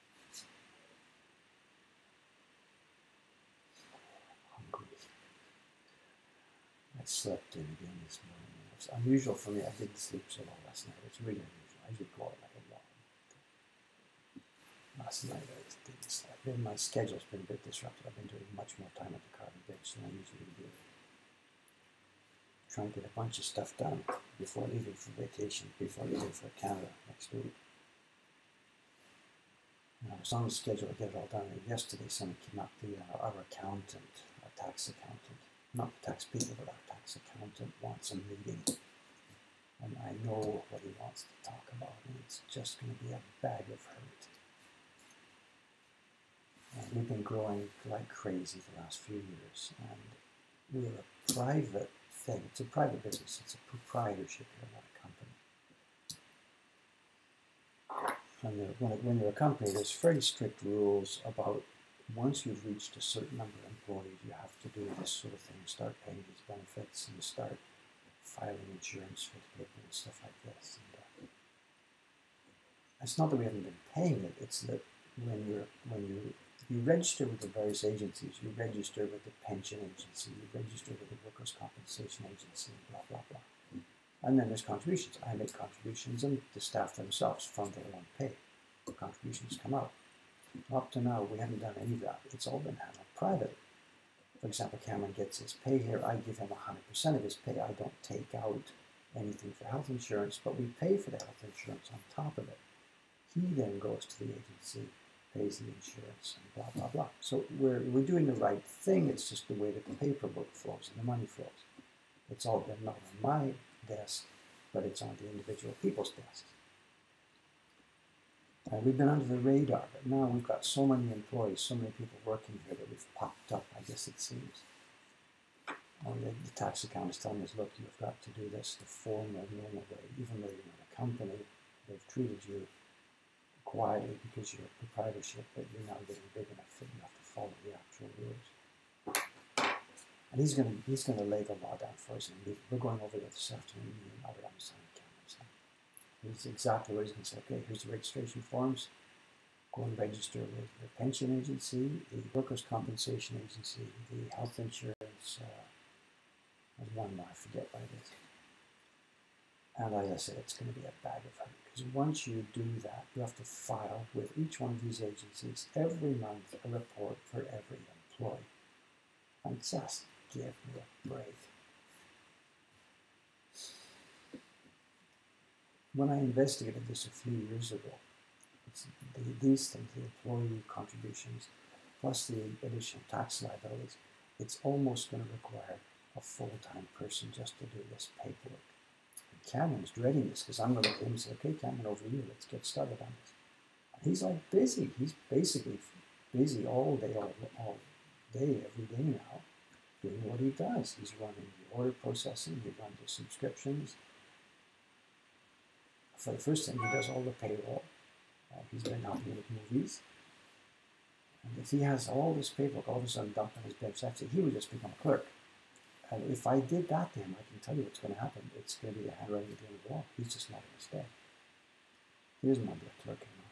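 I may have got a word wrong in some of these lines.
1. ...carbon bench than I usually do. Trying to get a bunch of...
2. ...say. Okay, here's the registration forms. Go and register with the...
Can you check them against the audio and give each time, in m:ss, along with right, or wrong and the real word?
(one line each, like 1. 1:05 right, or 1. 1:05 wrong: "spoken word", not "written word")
1. 0:19 right
2. 2:27 right.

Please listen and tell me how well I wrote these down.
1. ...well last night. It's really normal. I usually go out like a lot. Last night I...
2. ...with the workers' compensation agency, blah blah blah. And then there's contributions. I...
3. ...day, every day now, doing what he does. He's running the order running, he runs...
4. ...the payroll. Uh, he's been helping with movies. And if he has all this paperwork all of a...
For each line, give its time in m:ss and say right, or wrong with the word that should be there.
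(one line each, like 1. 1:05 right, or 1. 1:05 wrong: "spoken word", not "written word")
1. 0:10 wrong: "unusual", not "normal"
2. 1:20 right
3. 3:18 wrong: "processing", not "running"
4. 3:27 right.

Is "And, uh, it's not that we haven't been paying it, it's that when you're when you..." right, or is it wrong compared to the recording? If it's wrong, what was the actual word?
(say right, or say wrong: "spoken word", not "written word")
right.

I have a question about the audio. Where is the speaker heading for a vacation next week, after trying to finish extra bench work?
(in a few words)
Canada.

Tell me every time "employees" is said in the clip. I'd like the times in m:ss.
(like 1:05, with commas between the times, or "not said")
1:03, 2:01, 2:48, 3:00.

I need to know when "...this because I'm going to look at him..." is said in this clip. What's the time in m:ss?
3:10.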